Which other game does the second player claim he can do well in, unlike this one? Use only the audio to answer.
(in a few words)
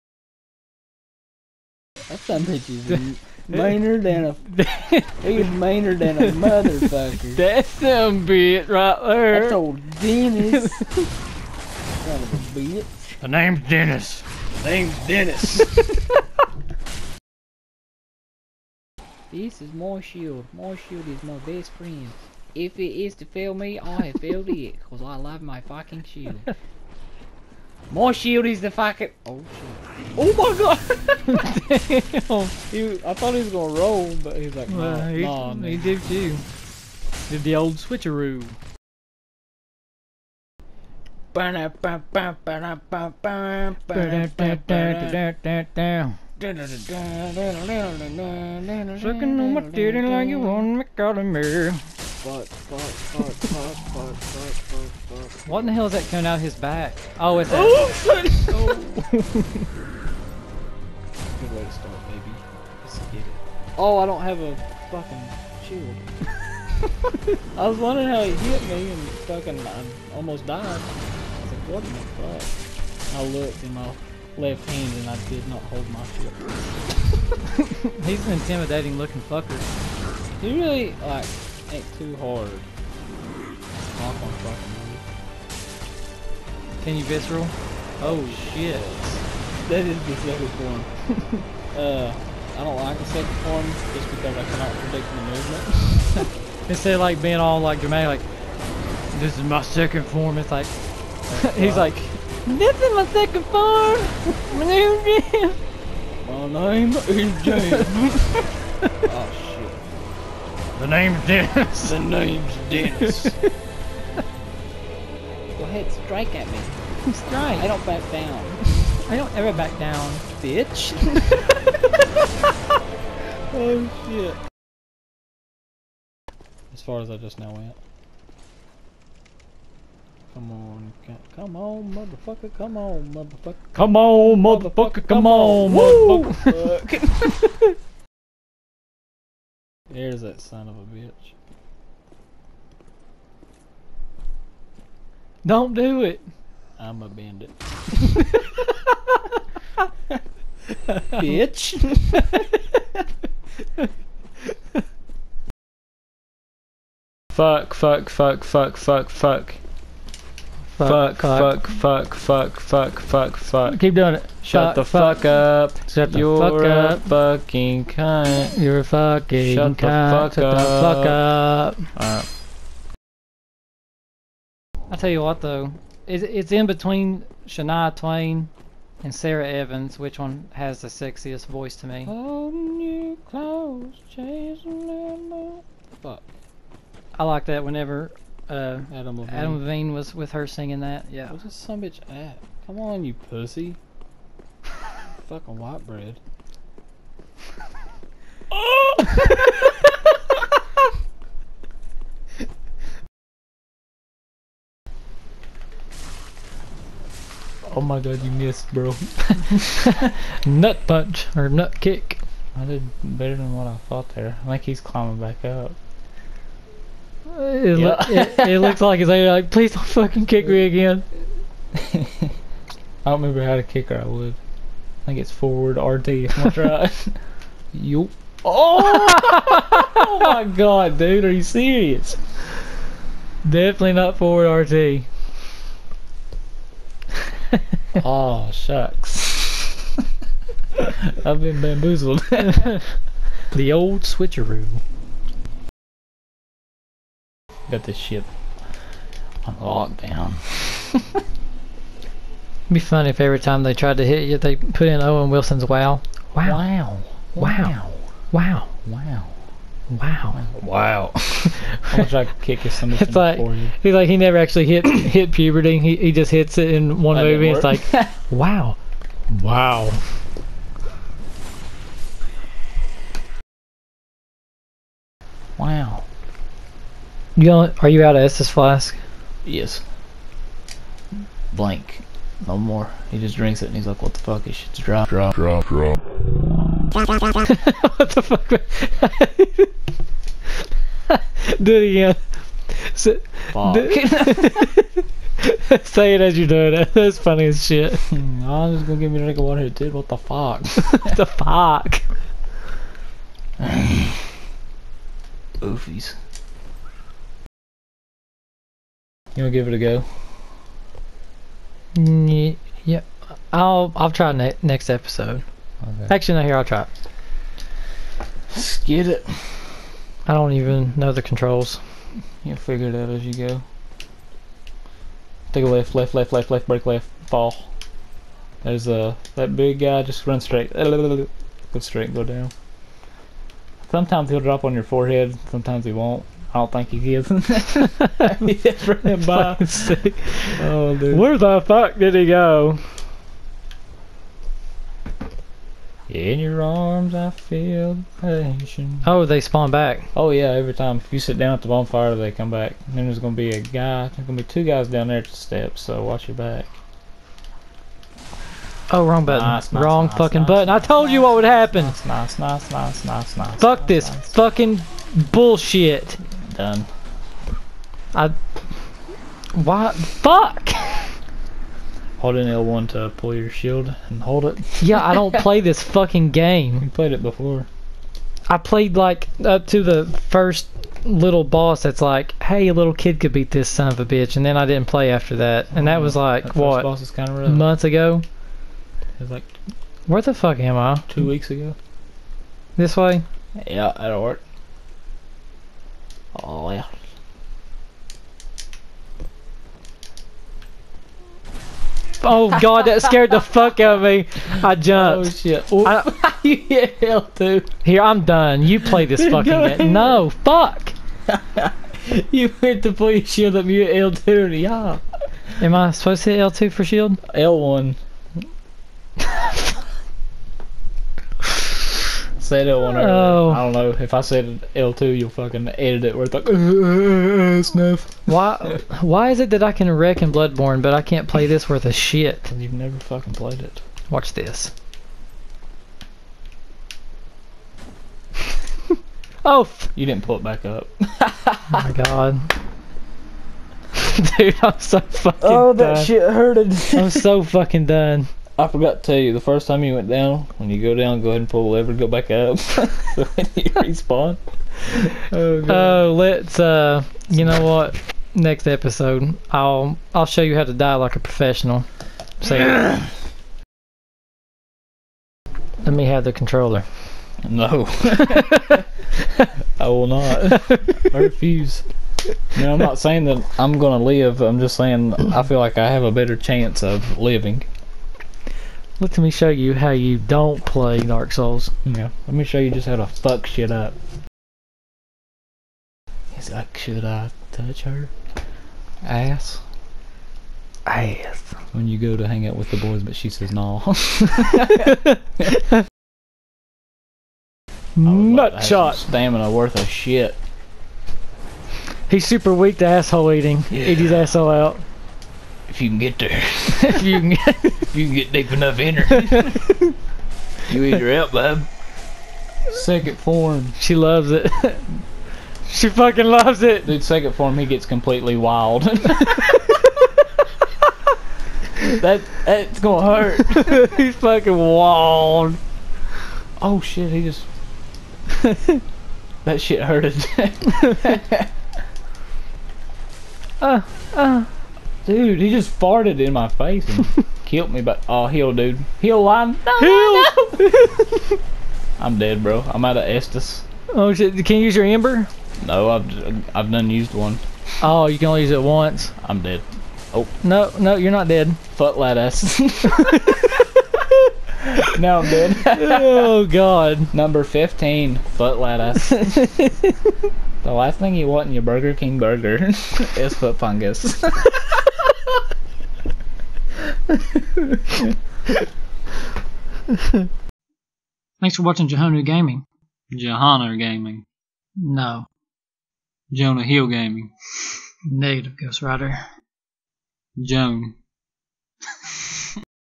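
Bloodborne.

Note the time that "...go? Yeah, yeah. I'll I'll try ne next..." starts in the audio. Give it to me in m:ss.
5:09.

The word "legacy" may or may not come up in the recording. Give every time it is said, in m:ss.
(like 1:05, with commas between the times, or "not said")
not said.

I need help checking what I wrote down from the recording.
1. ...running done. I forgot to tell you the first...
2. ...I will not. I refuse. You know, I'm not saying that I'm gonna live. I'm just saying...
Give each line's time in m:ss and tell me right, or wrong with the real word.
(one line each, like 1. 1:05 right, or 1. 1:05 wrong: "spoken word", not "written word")
1. 7:27 wrong: "fucking", not "running"
2. 7:49 right.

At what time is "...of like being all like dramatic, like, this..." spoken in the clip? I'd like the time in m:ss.
1:36.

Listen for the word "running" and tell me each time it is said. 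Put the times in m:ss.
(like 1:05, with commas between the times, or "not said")
5:38.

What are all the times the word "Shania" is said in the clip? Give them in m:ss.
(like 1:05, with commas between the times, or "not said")
2:57.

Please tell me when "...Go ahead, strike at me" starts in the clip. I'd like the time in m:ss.
1:55.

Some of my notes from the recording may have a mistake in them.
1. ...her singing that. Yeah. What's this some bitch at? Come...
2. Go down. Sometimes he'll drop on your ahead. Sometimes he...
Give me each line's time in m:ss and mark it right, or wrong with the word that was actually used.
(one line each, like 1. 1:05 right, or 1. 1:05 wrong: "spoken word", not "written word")
1. 3:10 right
2. 5:32 wrong: "forehead", not "ahead".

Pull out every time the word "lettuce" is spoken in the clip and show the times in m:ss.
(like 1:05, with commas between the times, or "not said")
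9:11, 9:18.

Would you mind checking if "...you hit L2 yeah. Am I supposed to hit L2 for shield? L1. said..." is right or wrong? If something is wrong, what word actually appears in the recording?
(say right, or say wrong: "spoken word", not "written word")
right.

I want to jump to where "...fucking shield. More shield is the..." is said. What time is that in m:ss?
0:25.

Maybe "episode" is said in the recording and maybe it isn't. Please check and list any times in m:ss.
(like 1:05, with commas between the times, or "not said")
5:14, 7:38.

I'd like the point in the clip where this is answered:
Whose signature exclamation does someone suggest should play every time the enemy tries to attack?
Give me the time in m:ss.
4:15.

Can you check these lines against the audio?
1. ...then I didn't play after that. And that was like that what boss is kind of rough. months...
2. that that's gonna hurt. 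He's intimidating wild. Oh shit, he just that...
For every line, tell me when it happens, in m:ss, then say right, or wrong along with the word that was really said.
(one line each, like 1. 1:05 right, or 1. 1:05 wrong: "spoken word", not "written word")
1. 6:24 right
2. 8:42 wrong: "fucking", not "intimidating".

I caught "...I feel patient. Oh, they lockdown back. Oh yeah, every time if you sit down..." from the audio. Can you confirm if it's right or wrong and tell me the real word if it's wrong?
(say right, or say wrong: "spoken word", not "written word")
wrong: "spawn", not "lockdown".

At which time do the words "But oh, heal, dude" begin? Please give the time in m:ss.
8:57.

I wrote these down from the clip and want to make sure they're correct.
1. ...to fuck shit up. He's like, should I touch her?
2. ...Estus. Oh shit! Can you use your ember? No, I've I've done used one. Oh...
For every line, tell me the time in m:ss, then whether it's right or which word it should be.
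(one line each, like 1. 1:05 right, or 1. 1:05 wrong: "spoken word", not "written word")
1. 8:02 right
2. 9:03 right.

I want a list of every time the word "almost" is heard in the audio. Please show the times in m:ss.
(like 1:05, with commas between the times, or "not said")
1:10.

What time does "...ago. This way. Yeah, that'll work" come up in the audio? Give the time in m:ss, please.
6:31.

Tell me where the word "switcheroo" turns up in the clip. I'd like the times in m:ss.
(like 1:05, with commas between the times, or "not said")
0:37, 4:04.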